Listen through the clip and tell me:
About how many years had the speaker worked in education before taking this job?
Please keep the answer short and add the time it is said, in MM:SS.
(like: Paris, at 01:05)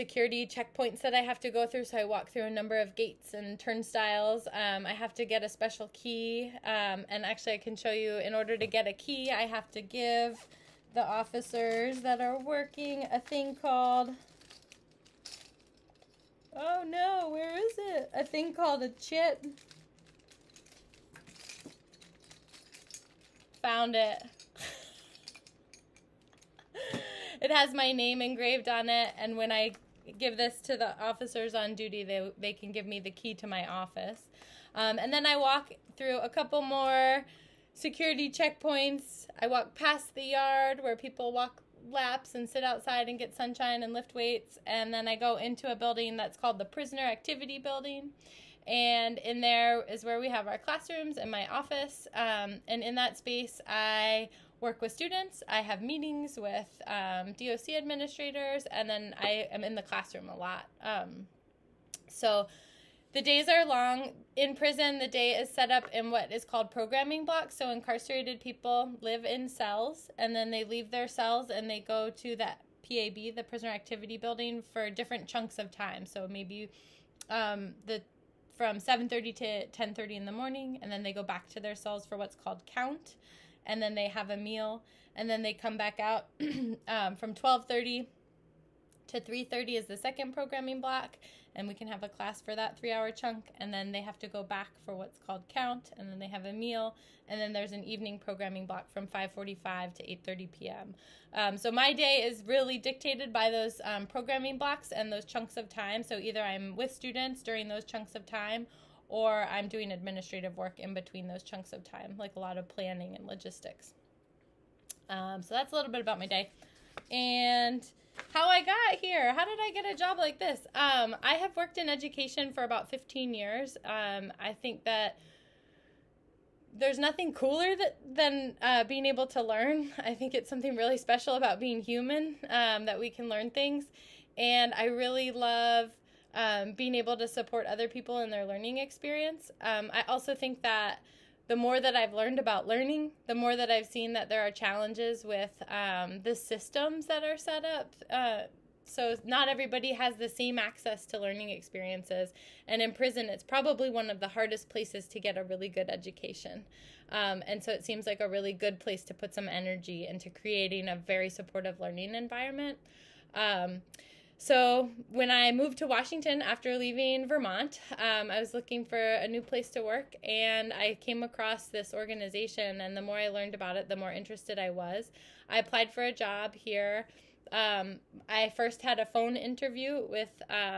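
15 years, at 02:02.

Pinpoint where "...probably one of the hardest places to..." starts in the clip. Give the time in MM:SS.
02:33.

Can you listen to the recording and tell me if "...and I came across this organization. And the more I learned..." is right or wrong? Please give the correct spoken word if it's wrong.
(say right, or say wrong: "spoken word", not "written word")
right.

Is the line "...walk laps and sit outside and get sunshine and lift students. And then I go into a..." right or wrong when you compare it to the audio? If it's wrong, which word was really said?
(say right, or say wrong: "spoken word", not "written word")
wrong: "weights", not "students".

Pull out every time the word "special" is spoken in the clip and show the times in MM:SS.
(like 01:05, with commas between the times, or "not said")
00:05, 02:10.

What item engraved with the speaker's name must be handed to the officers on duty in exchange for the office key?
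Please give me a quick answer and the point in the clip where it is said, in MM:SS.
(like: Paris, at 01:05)
Chip, at 00:18.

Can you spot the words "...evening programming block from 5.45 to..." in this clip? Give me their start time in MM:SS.
01:37.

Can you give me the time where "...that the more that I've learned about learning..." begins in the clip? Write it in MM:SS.
02:20.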